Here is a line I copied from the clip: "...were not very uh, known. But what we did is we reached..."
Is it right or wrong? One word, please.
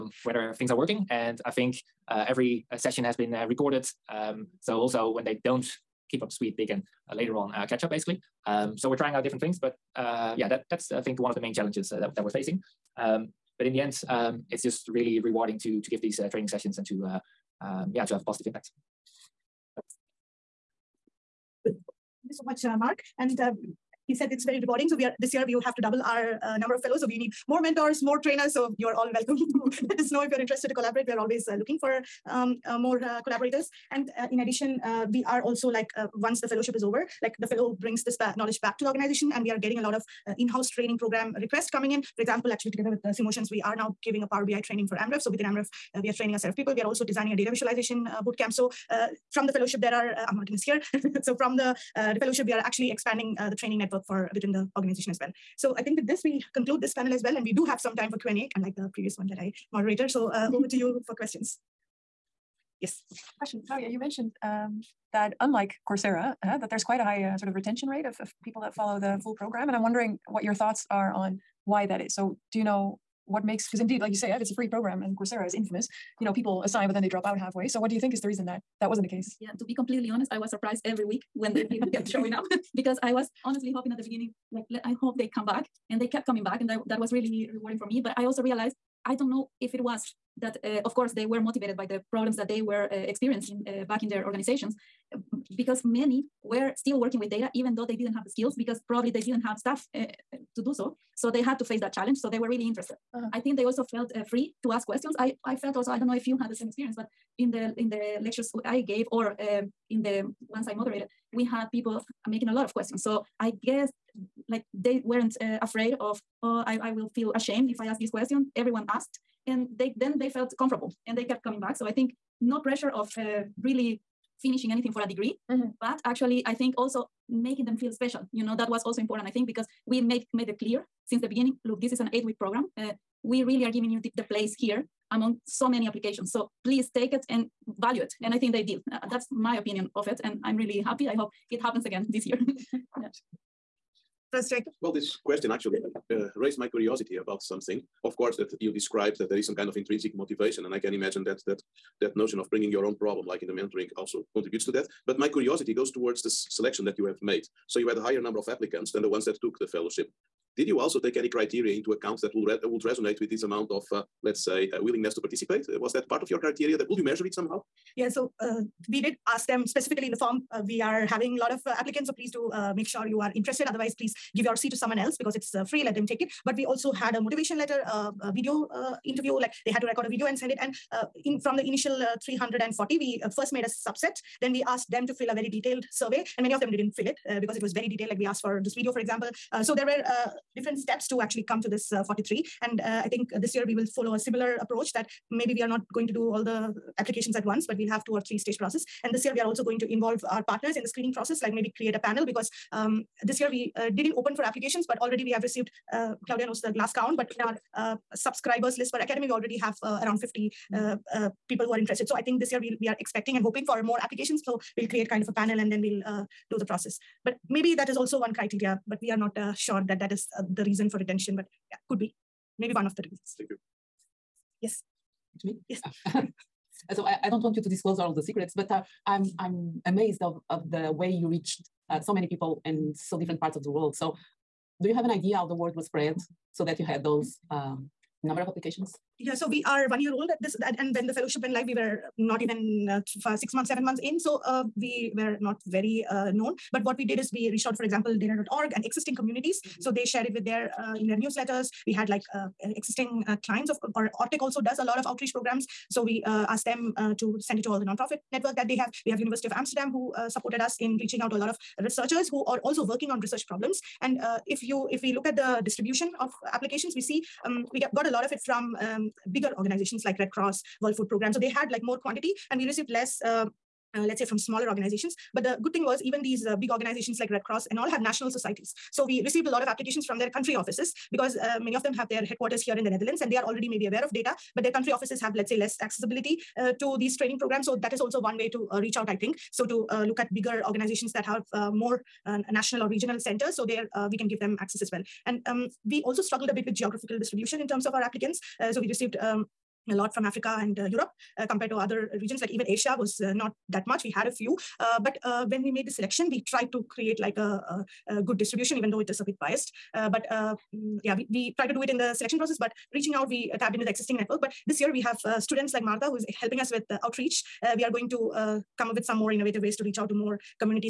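right.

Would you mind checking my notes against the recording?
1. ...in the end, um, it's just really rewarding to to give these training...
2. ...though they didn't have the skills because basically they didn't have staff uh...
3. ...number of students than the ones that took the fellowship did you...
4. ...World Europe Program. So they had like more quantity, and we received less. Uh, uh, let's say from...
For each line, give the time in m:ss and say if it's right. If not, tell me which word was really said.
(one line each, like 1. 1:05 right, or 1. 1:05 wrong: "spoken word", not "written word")
1. 0:13 right
2. 1:37 wrong: "probably", not "basically"
3. 2:38 wrong: "applicants", not "students"
4. 4:30 wrong: "Food", not "Europe".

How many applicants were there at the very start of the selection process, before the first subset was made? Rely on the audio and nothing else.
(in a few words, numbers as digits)
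340.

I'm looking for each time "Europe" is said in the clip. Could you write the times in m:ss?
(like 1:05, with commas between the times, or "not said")
5:00.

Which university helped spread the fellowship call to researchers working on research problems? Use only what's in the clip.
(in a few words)
University of Amsterdam.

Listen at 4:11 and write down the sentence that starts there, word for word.
We had like uh, existing uh, clients of or Ortec also does a lot of outreach programs.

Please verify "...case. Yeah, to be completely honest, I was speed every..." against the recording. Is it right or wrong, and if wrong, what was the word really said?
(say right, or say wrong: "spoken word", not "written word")
wrong: "surprised", not "speed".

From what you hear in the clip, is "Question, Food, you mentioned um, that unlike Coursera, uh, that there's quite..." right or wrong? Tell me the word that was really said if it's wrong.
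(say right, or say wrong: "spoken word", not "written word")
wrong: "Maria", not "Food".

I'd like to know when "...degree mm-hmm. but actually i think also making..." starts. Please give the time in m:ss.
2:05.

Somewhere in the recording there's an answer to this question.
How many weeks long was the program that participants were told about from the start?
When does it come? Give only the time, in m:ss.
2:12.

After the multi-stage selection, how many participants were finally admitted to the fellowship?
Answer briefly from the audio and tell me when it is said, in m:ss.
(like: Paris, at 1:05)
43, at 3:12.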